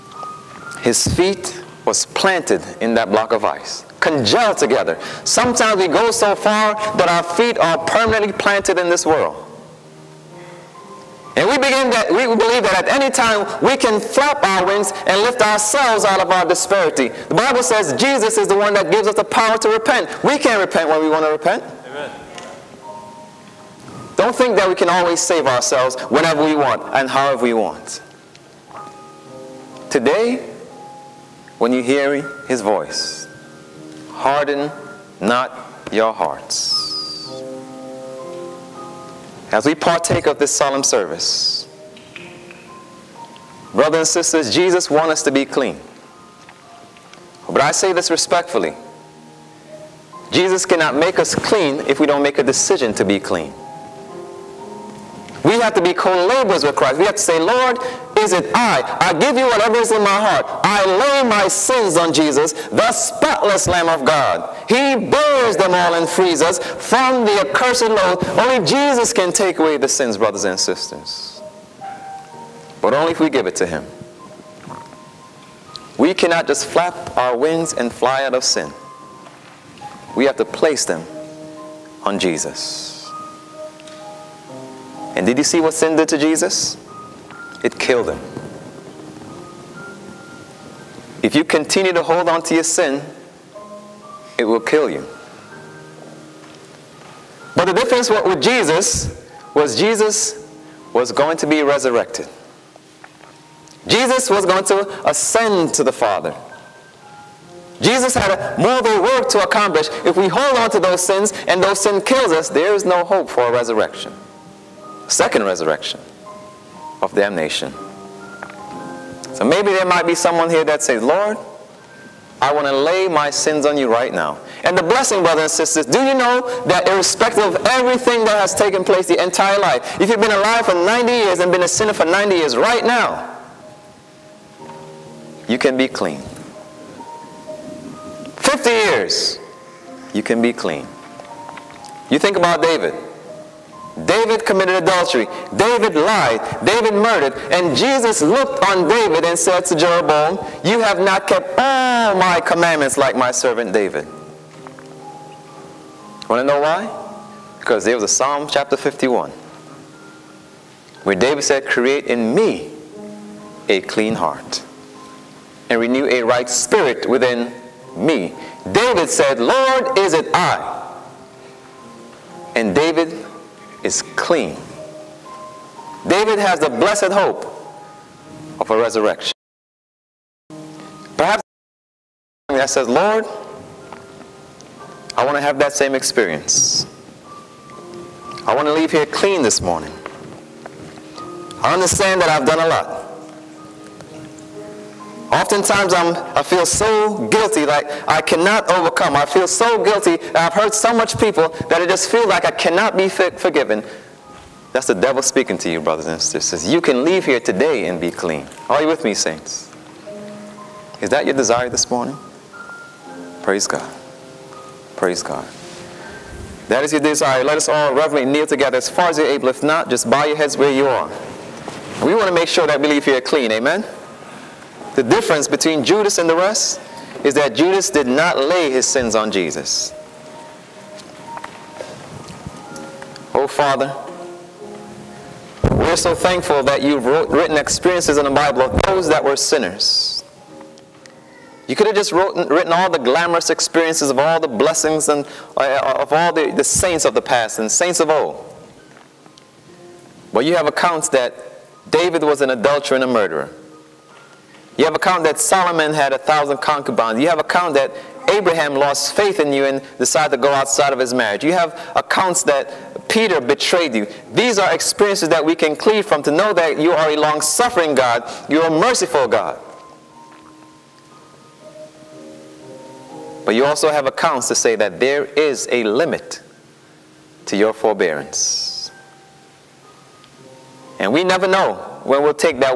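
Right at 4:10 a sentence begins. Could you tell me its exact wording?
But you have accounts that David was an adulterer and a murderer.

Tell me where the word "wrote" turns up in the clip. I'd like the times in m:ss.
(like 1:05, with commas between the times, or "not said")
3:57, 4:02.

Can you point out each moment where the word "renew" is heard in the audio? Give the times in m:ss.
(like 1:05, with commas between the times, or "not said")
2:45.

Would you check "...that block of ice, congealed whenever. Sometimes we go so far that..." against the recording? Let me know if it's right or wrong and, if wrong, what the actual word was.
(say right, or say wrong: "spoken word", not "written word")
wrong: "together", not "whenever".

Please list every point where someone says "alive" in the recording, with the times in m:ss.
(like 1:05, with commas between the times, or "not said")
2:10.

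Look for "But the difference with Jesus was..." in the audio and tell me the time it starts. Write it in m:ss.
1:37.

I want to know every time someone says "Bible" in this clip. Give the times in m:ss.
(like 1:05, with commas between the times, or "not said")
0:17, 3:58.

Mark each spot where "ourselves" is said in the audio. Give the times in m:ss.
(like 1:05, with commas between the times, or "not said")
0:15, 0:25.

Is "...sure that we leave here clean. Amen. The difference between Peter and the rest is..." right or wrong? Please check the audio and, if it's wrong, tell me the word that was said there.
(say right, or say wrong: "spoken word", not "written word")
wrong: "Judas", not "Peter".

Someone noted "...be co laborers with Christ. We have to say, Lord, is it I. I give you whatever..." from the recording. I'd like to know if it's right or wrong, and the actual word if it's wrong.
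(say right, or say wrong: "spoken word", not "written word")
right.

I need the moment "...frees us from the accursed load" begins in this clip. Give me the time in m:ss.
1:06.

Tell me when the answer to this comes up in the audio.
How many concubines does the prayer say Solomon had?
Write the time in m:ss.
4:16.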